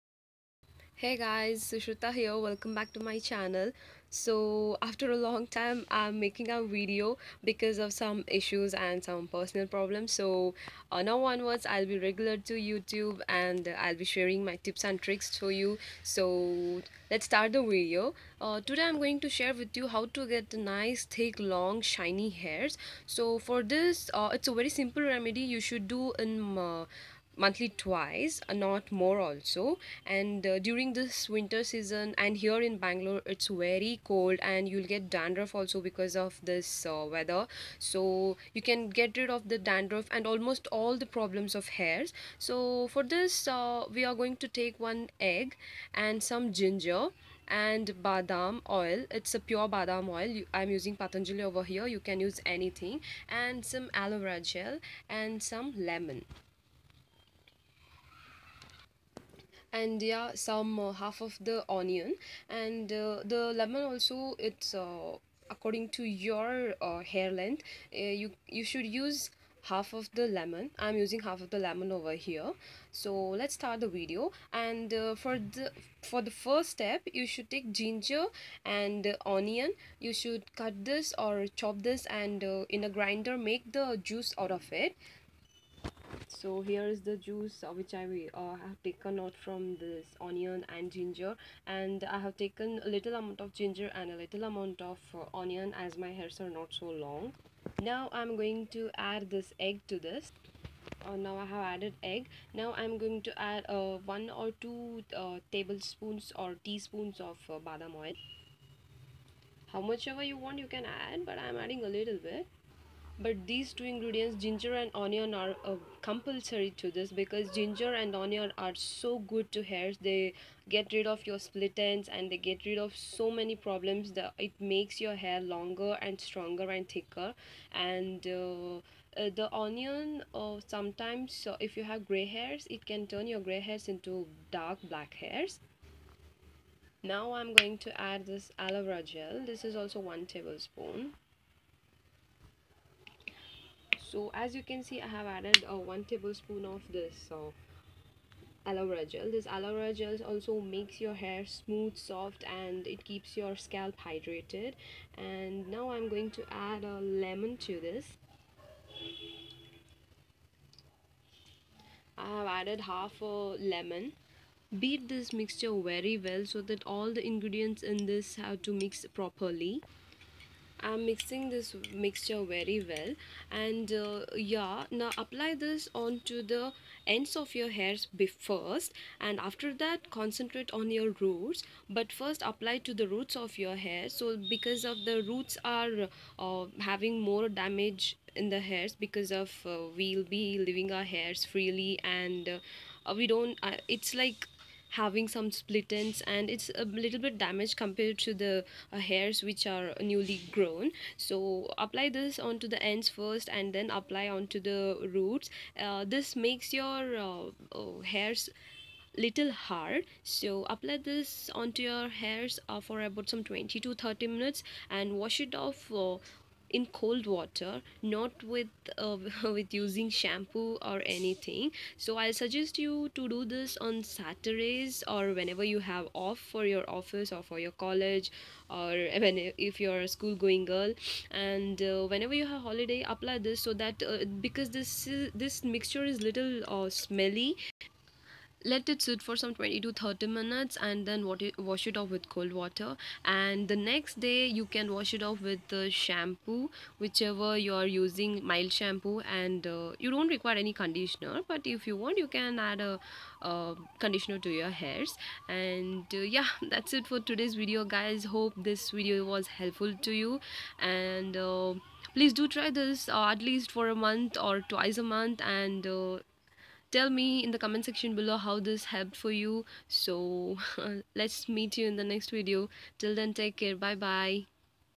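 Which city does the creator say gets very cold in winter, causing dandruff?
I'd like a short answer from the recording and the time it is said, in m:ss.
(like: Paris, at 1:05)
Bangalore, at 0:32.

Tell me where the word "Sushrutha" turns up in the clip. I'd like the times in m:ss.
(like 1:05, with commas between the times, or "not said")
0:01.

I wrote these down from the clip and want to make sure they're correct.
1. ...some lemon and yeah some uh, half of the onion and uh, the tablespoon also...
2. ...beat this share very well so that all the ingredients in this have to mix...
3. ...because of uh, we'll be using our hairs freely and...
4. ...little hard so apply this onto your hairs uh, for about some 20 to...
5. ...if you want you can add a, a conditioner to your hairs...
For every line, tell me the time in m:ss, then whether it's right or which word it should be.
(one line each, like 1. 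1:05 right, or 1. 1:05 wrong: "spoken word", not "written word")
1. 0:55 wrong: "lemon", not "tablespoon"
2. 2:44 wrong: "mixture", not "share"
3. 3:08 wrong: "leaving", not "using"
4. 3:29 right
5. 4:11 right.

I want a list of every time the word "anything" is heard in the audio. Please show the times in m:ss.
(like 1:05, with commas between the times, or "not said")
0:52, 3:41.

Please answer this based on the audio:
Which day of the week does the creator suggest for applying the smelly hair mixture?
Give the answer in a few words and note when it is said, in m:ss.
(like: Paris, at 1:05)
Saturdays, at 3:44.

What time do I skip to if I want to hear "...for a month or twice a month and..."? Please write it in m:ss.
4:23.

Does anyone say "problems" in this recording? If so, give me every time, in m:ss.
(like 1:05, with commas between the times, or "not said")
0:09, 0:41, 2:03.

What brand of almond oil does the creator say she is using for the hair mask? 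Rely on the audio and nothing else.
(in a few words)
Patanjali.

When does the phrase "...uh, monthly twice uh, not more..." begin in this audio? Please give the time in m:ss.
0:26.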